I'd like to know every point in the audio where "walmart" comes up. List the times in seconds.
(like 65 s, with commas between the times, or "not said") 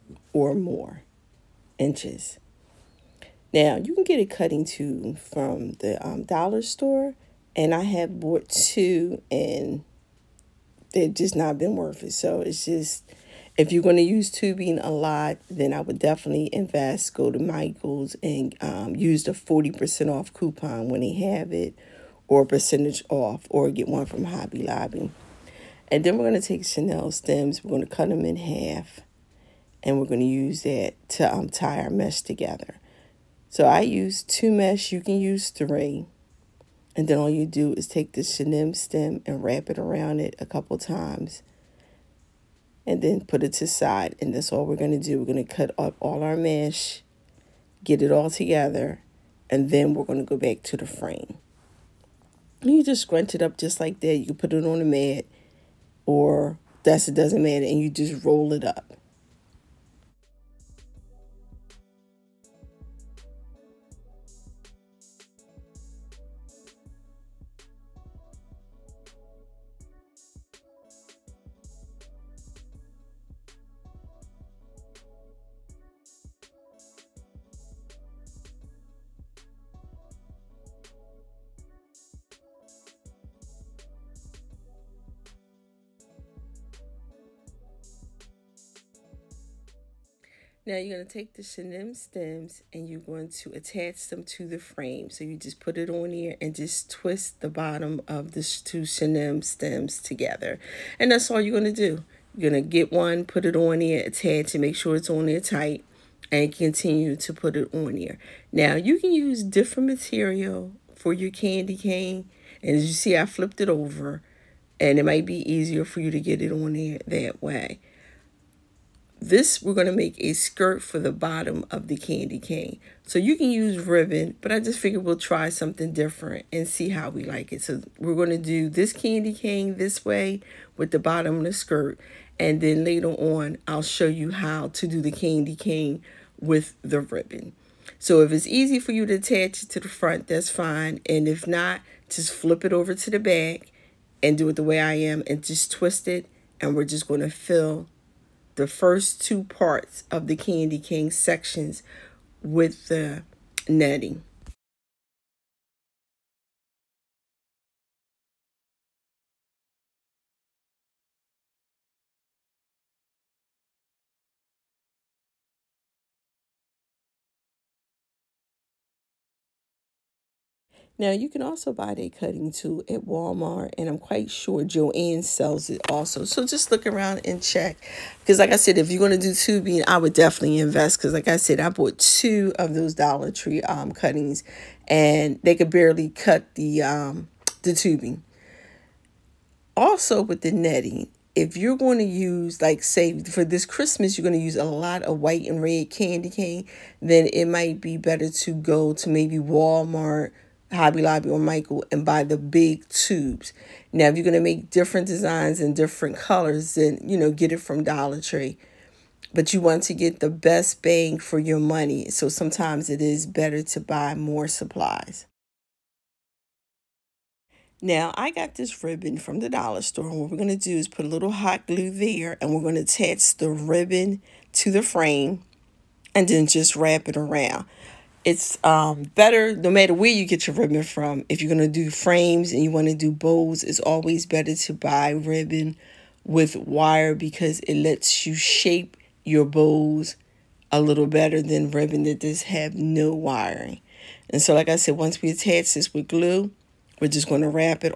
173 s, 199 s.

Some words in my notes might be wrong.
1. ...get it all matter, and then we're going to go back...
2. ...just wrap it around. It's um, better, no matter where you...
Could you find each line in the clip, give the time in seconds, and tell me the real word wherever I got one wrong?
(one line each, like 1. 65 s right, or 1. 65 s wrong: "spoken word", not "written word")
1. 47 s wrong: "together", not "matter"
2. 226 s right.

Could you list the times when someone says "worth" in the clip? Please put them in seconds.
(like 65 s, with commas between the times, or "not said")
11 s.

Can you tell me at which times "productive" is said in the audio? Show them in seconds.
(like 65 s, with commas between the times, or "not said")
not said.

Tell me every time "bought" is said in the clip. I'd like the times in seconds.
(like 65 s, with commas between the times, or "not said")
8 s, 181 s.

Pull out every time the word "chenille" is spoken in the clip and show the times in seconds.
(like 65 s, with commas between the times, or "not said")
26 s, 38 s, 91 s, 98 s.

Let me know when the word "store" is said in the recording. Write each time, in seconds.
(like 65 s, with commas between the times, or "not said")
6 s, 219 s.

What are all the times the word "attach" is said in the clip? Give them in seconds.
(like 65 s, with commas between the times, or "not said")
93 s, 104 s, 139 s, 222 s, 245 s.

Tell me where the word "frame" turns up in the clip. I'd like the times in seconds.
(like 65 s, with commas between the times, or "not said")
50 s, 94 s, 224 s, 231 s.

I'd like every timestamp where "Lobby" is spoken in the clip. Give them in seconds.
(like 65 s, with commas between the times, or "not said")
24 s, 201 s.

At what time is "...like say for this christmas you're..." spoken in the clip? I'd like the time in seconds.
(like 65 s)
192 s.